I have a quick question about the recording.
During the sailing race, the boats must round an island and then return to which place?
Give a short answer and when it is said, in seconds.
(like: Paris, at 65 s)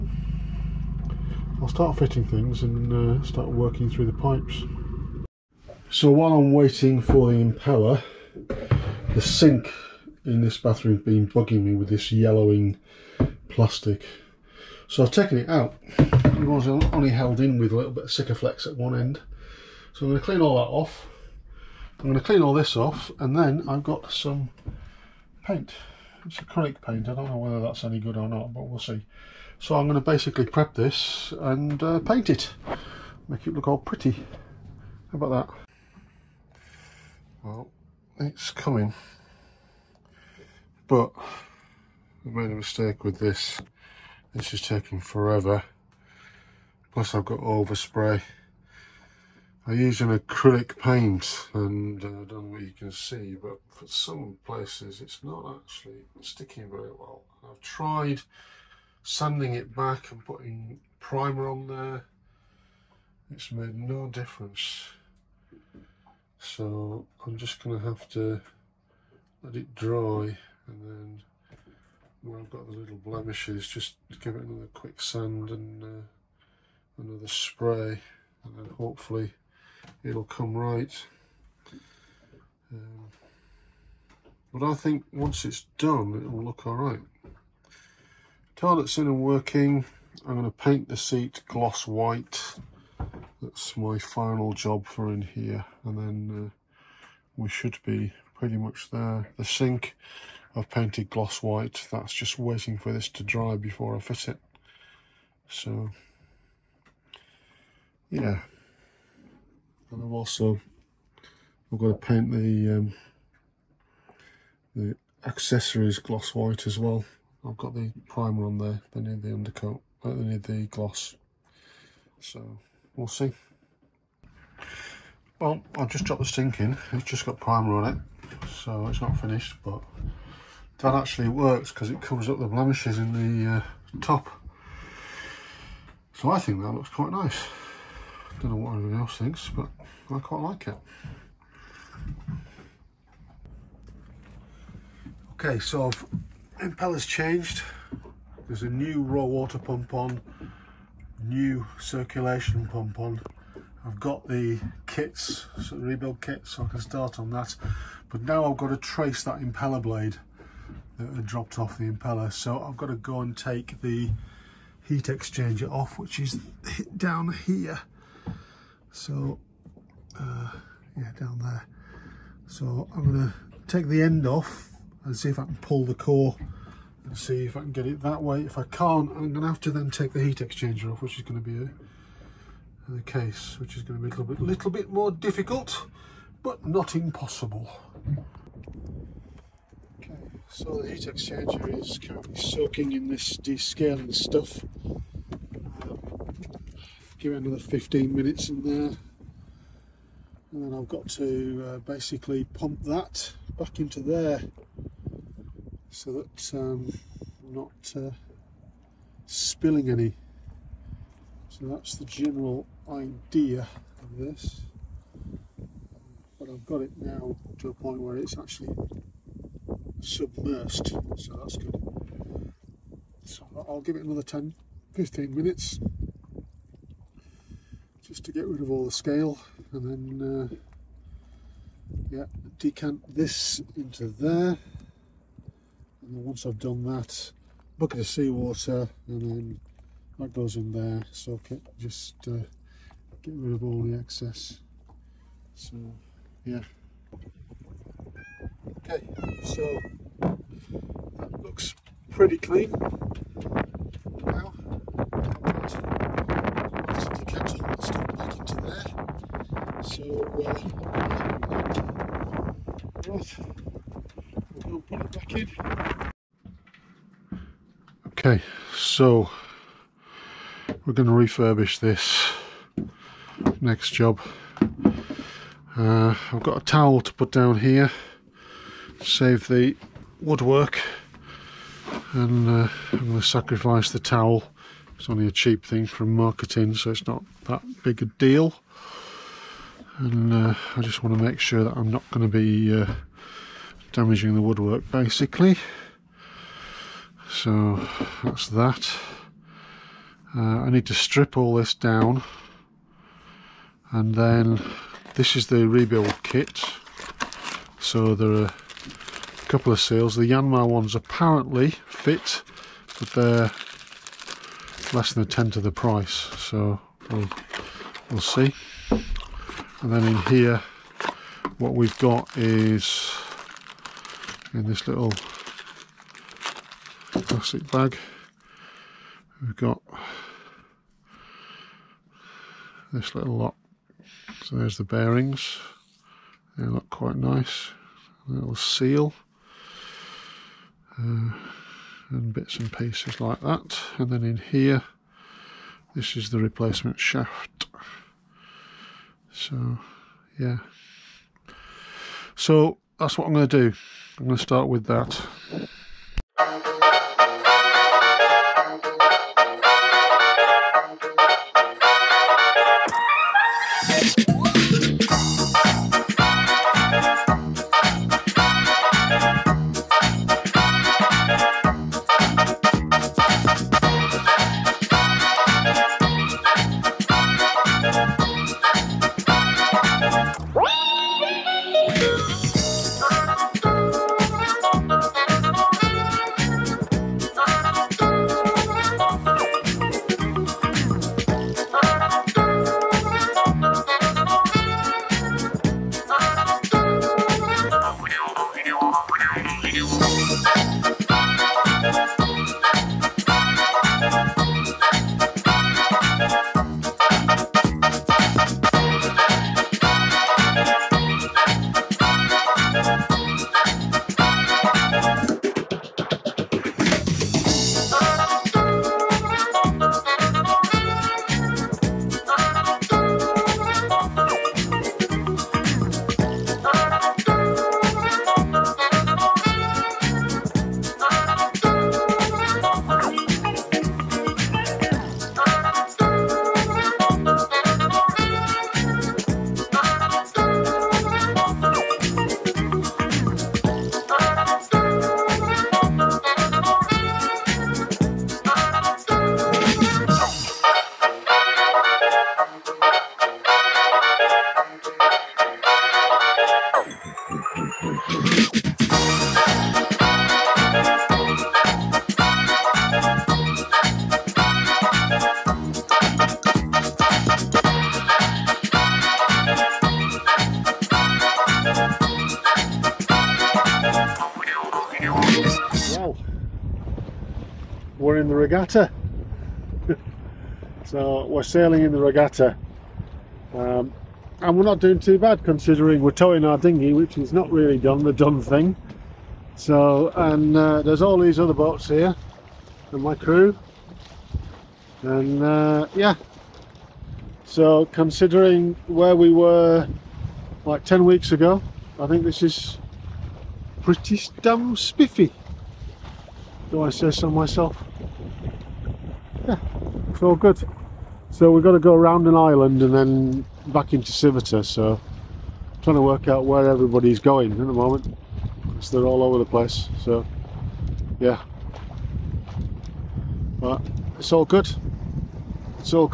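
Sivota, at 514 s.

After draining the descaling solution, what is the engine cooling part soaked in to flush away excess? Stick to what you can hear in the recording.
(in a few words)
Seawater.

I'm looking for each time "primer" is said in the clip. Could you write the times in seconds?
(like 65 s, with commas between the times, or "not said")
60 s, 118 s, 127 s.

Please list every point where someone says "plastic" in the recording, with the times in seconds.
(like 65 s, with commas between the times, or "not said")
13 s, 327 s.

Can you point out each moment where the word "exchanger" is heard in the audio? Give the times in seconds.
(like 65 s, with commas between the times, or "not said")
165 s, 180 s, 191 s.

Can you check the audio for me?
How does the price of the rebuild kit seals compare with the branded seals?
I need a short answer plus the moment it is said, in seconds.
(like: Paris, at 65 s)
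Less than a tenth, at 314 s.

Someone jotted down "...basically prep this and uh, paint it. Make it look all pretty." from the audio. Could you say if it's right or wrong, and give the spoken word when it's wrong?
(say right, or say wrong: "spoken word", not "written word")
right.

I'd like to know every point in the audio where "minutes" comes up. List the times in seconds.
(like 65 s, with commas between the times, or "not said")
198 s, 225 s.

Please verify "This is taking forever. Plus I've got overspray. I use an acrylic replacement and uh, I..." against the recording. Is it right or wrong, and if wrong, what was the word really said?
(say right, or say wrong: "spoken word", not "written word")
wrong: "paint", not "replacement".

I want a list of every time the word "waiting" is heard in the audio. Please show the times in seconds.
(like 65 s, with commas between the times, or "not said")
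6 s, 102 s.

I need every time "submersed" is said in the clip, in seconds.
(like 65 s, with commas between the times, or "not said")
219 s.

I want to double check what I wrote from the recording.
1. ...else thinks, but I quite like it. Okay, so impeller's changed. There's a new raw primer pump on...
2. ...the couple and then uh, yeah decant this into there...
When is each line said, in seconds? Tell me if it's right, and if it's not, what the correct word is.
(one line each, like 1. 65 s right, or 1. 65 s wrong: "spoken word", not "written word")
1. 138 s wrong: "water", not "primer"
2. 228 s wrong: "scale", not "couple".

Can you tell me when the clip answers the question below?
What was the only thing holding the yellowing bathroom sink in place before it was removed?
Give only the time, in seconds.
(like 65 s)
18 s.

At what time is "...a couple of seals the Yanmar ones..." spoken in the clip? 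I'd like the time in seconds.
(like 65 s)
308 s.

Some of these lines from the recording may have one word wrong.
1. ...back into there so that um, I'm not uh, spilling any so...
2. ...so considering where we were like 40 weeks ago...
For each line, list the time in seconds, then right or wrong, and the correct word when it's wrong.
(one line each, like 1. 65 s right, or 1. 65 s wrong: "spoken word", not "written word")
1. 203 s right
2. 497 s wrong: "10", not "40".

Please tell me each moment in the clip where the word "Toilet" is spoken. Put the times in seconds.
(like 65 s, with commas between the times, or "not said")
88 s.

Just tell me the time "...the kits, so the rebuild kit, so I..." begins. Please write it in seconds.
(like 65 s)
154 s.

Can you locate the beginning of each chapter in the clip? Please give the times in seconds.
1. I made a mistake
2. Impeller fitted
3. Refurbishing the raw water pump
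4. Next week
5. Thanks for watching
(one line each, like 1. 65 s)
1. 35 s
2. 143 s
3. 265 s
4. 476 s
5. 506 s.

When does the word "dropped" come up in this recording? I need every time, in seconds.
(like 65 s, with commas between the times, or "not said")
126 s, 161 s.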